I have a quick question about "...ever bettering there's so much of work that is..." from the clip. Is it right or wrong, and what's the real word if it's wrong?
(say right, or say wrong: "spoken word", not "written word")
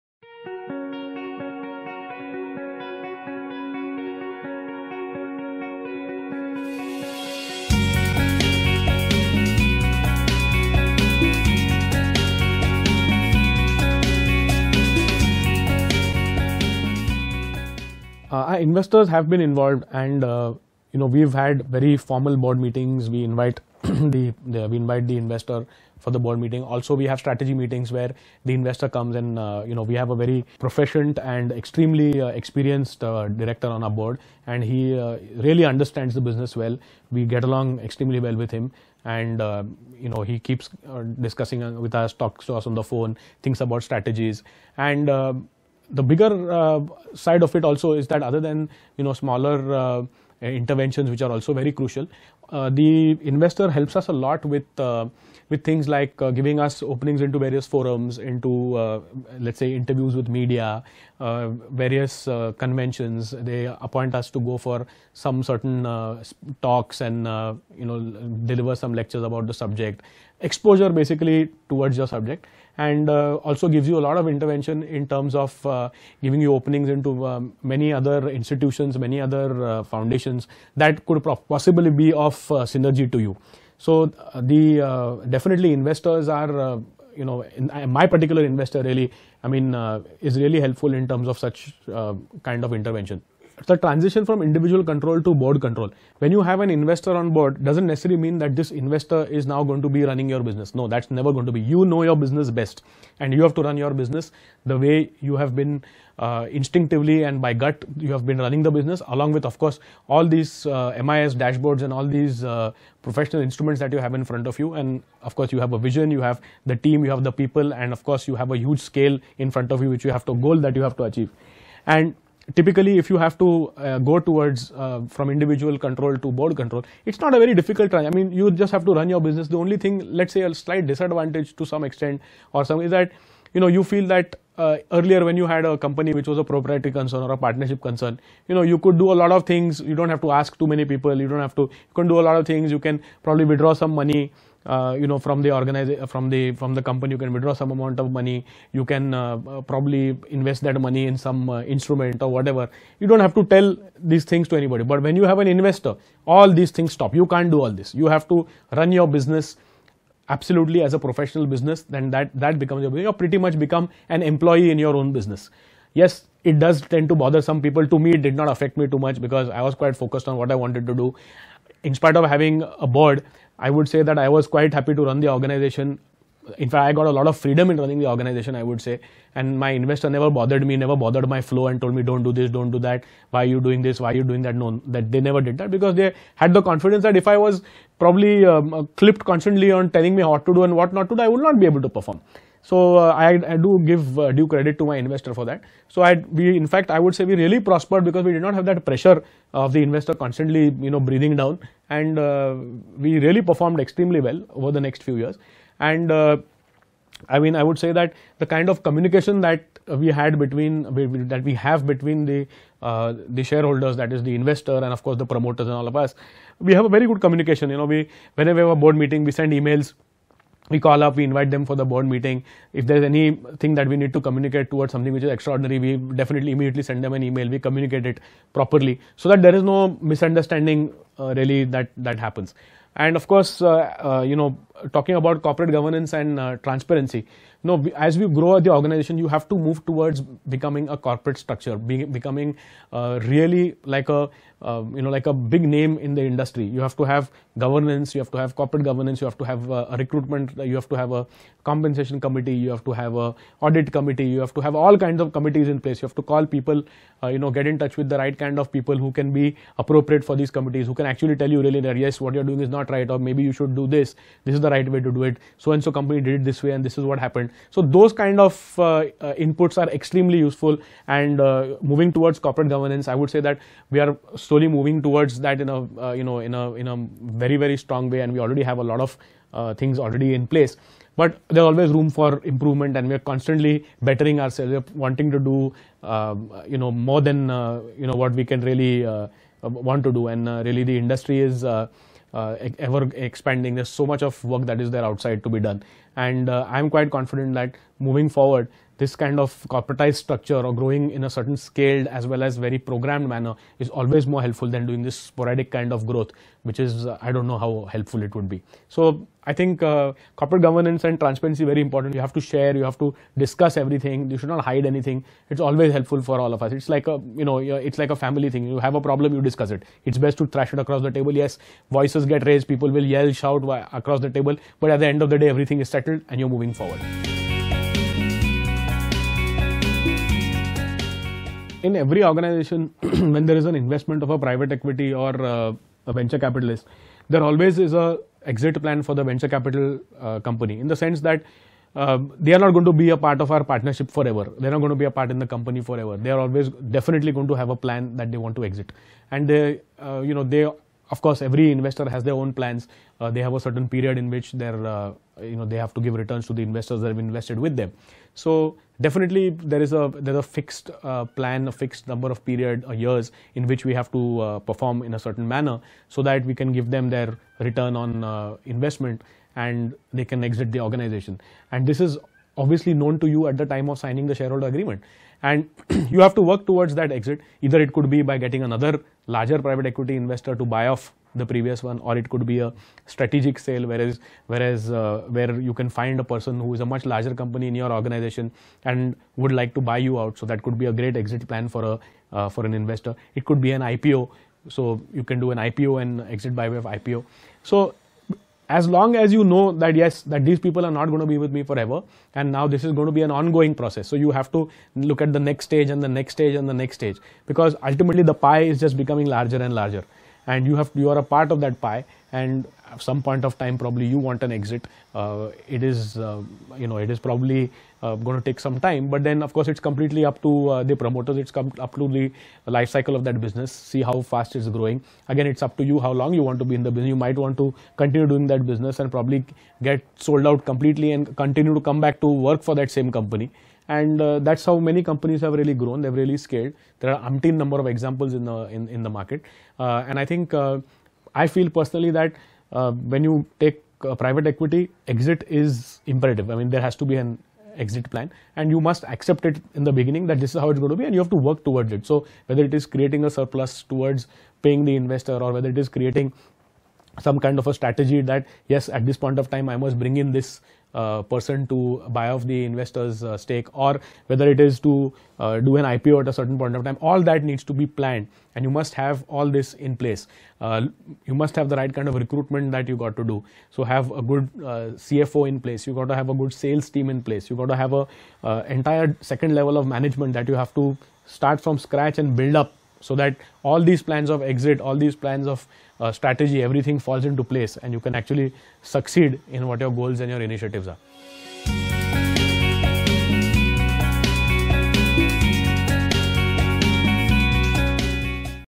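wrong: "expanding", not "bettering".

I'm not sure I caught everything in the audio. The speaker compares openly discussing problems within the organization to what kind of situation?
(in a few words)
a family thing.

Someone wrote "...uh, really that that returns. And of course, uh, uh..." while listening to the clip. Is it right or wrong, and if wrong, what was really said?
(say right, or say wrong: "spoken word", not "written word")
wrong: "happens", not "returns".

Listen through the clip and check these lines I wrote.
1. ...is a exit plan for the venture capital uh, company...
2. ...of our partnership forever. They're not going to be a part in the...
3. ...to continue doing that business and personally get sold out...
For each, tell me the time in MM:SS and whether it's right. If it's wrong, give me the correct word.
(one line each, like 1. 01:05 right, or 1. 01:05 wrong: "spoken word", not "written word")
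1. 05:37 right
2. 05:43 right
3. 07:07 wrong: "probably", not "personally".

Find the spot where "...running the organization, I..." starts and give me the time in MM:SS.
02:57.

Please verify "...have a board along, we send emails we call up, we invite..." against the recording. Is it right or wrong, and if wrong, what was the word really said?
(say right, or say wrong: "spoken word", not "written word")
wrong: "meeting", not "along".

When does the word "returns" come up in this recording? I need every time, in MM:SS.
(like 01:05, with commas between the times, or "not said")
05:56, 06:07.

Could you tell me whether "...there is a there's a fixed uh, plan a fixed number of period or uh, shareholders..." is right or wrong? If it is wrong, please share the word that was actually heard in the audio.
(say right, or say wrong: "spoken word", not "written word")
wrong: "years", not "shareholders".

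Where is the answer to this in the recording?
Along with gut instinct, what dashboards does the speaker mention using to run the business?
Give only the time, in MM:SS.
01:51.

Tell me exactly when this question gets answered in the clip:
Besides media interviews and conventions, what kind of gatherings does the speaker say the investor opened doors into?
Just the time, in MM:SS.
00:57.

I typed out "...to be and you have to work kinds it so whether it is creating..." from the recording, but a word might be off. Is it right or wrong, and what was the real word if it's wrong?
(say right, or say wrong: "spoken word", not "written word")
wrong: "towards", not "kinds".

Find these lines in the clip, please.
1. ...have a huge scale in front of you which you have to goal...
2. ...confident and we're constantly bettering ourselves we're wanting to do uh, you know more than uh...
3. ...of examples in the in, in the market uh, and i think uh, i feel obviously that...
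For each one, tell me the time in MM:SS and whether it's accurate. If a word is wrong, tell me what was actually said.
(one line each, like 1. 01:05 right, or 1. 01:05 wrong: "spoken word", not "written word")
1. 01:58 right
2. 04:42 wrong: "improvement", not "confident"
3. 07:17 wrong: "personally", not "obviously".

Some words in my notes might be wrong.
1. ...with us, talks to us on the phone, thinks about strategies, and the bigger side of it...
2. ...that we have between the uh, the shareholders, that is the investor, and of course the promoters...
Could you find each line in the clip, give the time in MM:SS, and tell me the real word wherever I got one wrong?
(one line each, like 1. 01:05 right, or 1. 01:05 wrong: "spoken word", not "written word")
1. 00:41 right
2. 03:31 right.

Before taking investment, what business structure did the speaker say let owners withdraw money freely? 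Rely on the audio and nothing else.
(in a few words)
proprietary concern.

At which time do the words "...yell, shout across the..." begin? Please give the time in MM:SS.
05:23.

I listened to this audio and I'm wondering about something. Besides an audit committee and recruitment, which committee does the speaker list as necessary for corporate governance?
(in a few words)
compensation committee.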